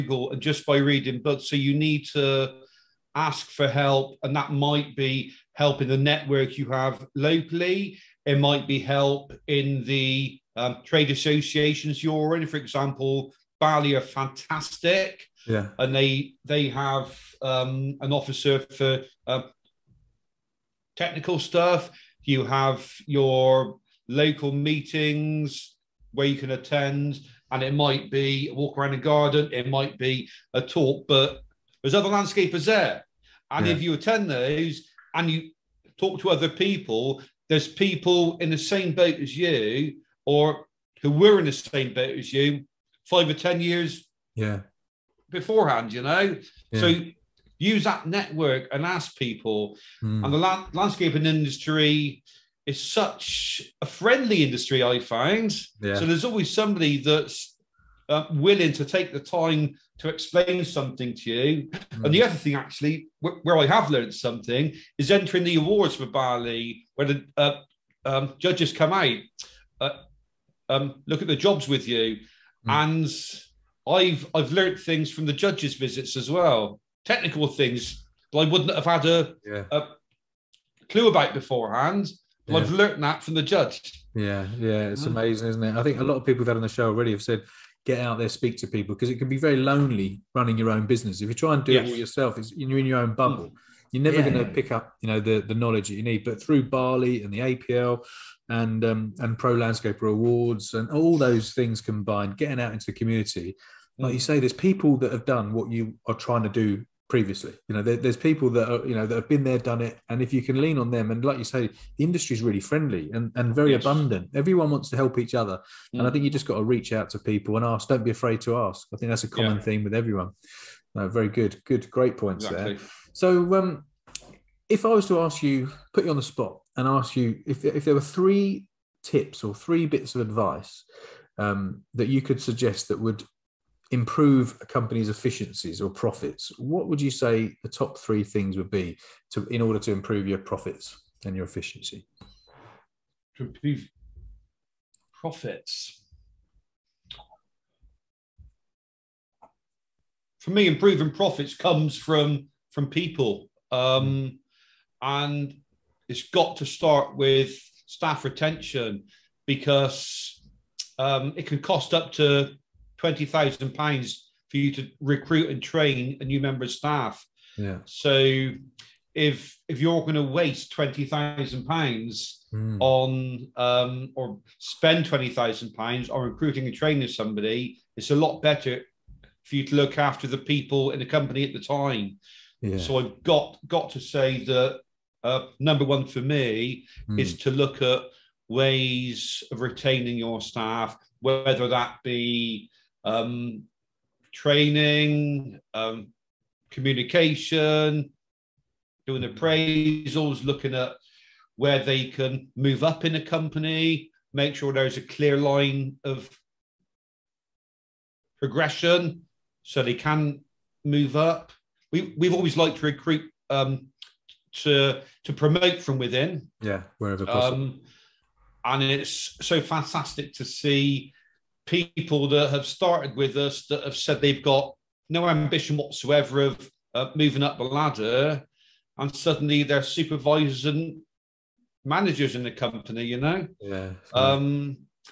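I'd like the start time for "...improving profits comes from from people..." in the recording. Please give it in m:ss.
2:30.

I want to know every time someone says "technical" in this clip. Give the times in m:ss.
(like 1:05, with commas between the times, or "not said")
0:20, 1:17.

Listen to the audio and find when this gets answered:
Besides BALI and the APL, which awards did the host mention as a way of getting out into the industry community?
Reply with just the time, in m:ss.
1:39.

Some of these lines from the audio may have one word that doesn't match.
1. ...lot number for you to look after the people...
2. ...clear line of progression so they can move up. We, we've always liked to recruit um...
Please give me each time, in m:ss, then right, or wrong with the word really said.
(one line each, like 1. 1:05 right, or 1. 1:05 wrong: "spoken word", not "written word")
1. 2:58 wrong: "better", not "number"
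2. 3:25 right.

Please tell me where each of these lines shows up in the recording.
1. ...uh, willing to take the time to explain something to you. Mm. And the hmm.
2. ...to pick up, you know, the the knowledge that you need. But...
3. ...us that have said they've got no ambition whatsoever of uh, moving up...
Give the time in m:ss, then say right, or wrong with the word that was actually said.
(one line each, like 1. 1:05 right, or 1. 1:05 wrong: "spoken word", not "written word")
1. 0:58 right
2. 1:34 right
3. 3:43 right.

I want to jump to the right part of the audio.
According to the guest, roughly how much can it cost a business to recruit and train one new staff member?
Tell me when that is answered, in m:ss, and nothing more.
2:43.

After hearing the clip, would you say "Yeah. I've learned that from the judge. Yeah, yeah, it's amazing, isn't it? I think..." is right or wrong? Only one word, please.
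right.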